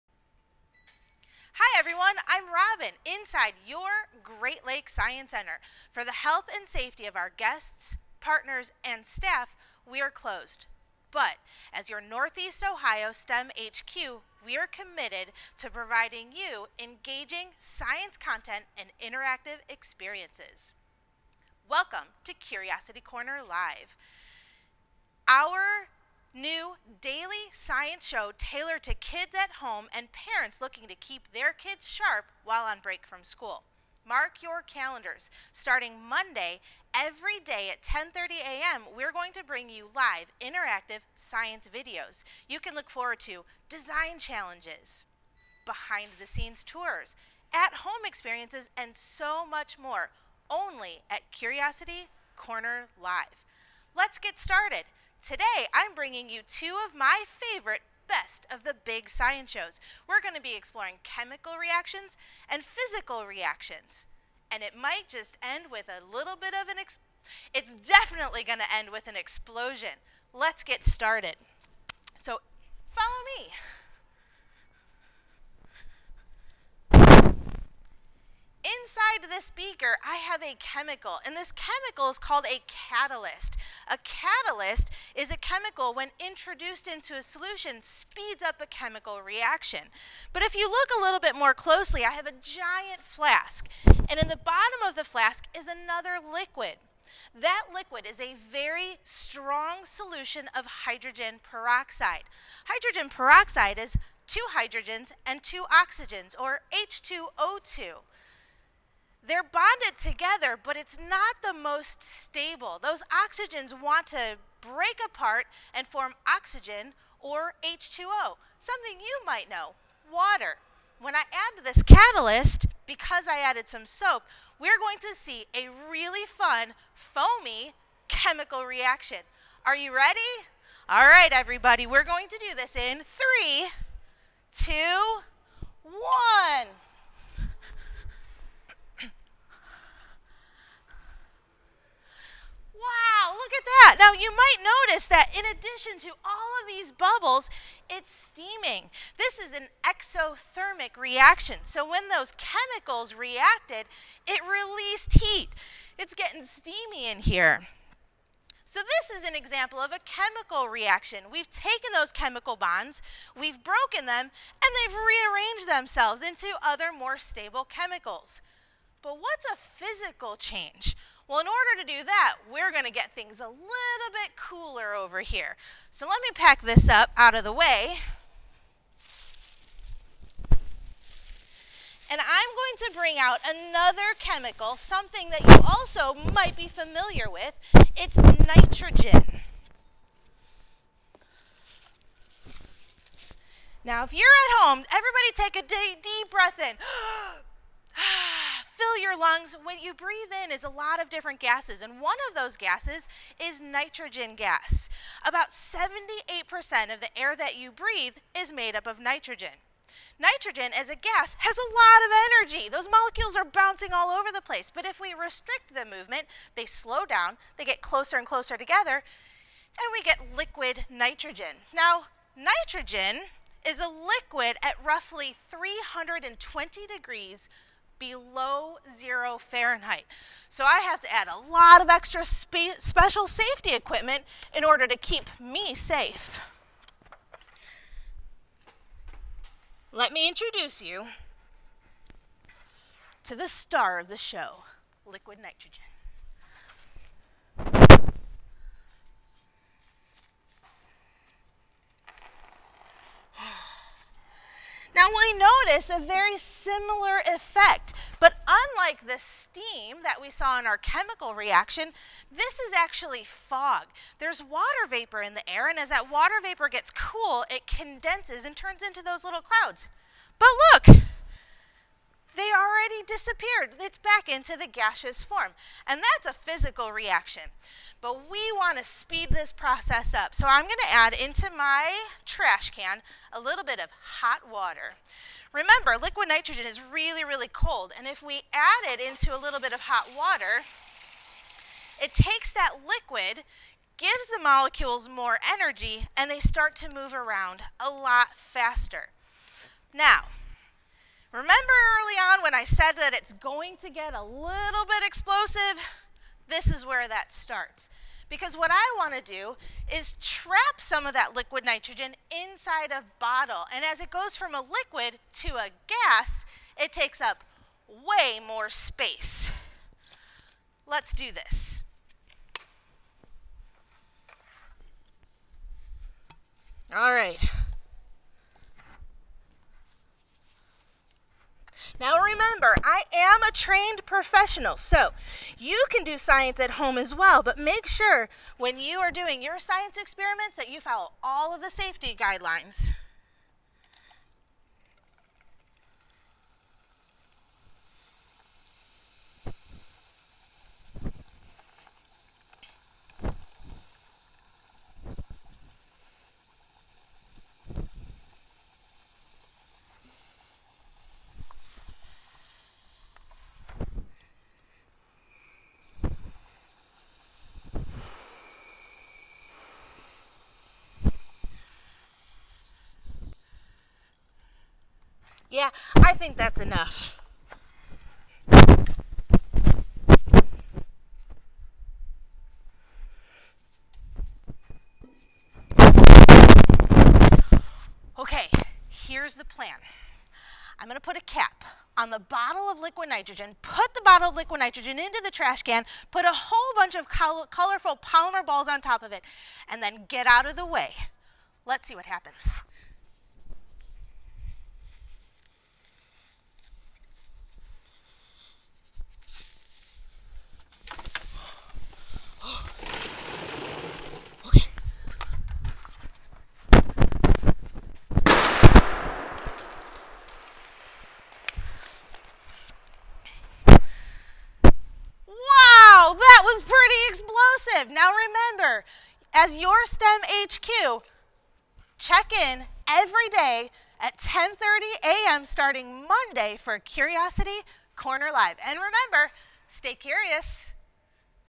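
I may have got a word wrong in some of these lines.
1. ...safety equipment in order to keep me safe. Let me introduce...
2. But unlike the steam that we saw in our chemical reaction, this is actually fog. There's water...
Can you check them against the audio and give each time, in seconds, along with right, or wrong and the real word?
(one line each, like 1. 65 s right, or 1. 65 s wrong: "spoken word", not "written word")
1. 233 s right
2. 258 s right.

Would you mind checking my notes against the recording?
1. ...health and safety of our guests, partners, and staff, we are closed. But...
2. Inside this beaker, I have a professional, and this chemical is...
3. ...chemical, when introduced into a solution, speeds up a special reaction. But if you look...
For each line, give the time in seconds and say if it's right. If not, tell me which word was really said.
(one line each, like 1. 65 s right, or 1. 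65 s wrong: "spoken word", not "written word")
1. 6 s right
2. 78 s wrong: "chemical", not "professional"
3. 85 s wrong: "chemical", not "special".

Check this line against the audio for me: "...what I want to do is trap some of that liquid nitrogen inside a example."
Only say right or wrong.
wrong.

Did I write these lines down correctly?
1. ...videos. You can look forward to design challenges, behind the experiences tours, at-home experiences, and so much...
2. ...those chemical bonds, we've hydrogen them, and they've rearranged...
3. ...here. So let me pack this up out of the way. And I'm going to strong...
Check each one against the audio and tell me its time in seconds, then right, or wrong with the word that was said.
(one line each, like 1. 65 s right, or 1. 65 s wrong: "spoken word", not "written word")
1. 41 s wrong: "scenes", not "experiences"
2. 161 s wrong: "broken", not "hydrogen"
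3. 175 s wrong: "bring", not "strong".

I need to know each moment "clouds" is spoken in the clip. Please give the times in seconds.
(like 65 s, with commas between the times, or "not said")
269 s.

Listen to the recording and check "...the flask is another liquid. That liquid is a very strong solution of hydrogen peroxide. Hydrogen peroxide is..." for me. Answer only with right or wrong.
right.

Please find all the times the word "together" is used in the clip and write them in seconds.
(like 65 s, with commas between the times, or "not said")
110 s, 218 s.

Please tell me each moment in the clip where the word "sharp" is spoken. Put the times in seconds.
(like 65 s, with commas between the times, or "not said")
31 s.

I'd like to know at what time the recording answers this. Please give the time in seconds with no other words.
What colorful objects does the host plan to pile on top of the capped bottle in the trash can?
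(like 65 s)
398 s.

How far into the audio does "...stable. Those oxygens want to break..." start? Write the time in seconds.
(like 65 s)
112 s.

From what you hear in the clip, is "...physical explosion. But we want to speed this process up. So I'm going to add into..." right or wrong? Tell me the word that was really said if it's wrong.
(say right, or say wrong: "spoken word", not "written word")
wrong: "reaction", not "explosion".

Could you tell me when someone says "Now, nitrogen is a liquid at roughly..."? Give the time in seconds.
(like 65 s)
221 s.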